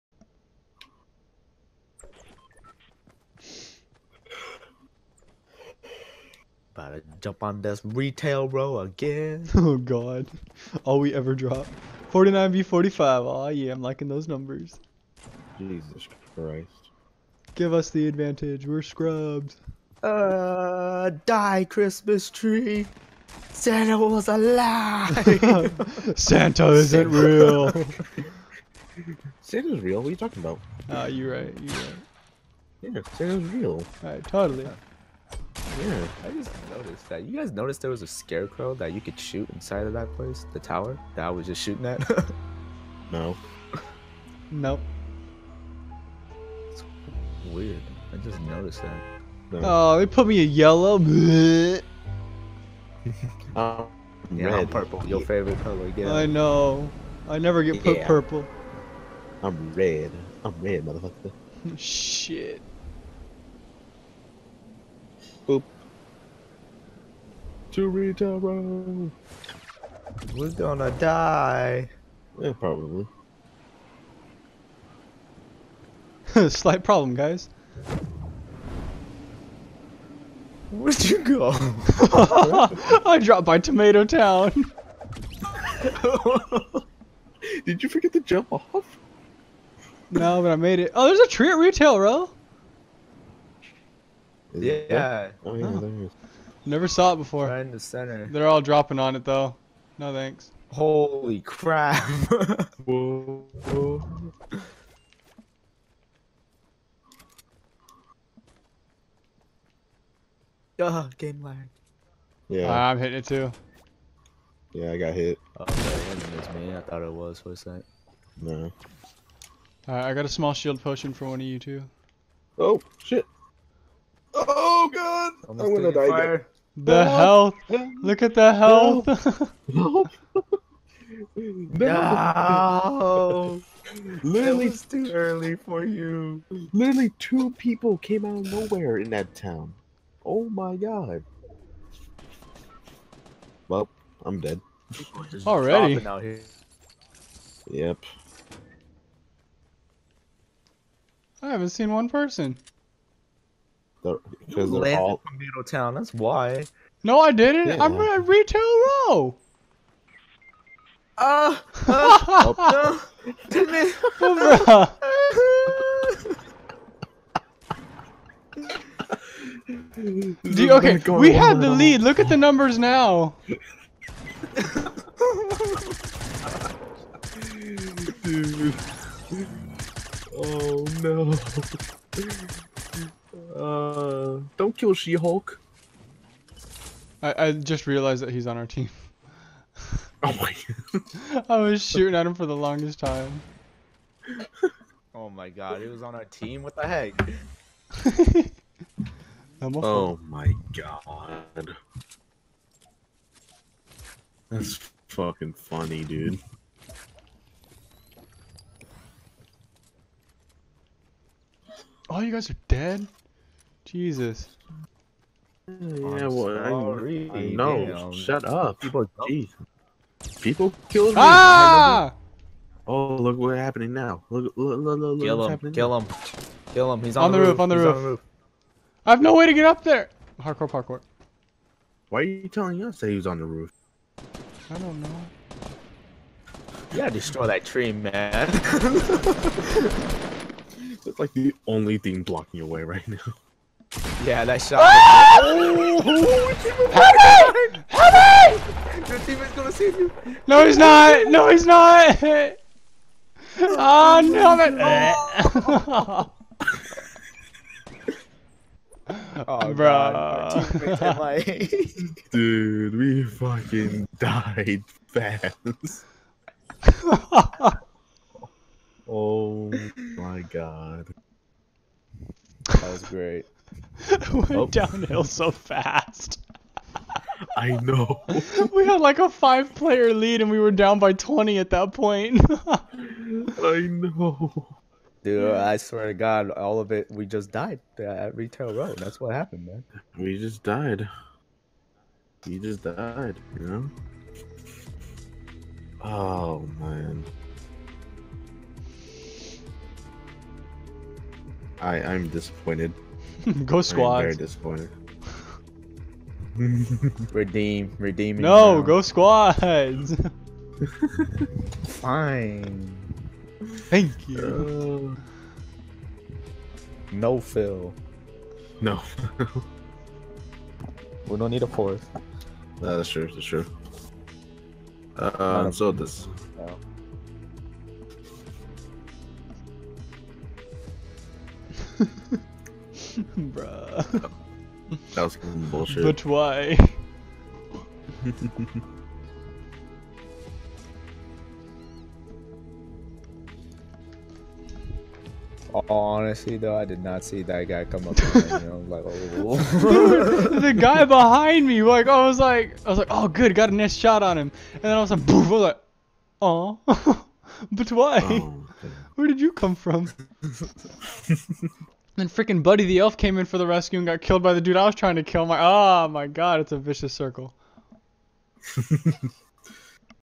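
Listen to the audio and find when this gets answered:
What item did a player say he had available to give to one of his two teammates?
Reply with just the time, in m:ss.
2:00.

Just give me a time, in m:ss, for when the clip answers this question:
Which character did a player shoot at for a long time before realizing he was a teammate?
3:04.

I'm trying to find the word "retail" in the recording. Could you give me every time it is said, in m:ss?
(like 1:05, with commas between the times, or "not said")
0:07, 1:31, 2:38, 4:48.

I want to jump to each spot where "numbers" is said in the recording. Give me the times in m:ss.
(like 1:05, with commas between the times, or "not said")
0:14, 2:52.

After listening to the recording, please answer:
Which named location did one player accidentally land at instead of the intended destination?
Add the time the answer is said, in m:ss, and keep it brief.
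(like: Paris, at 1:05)
Tomato Town, at 1:23.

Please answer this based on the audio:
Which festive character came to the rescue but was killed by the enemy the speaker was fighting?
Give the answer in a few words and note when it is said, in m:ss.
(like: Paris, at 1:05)
Buddy the Elf, at 6:02.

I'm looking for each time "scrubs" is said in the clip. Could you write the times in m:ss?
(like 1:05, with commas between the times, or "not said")
0:18.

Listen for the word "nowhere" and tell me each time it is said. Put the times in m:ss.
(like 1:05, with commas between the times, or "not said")
2:18.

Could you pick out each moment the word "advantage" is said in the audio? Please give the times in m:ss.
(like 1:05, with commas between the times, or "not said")
0:18.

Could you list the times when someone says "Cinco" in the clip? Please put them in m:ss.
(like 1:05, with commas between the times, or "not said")
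not said.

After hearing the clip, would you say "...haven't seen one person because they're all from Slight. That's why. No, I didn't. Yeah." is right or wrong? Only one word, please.
wrong.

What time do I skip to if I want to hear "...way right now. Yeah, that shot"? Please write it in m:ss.
4:02.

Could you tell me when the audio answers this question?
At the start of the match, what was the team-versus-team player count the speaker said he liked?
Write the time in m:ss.
0:12.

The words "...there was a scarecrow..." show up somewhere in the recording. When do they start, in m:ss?
0:37.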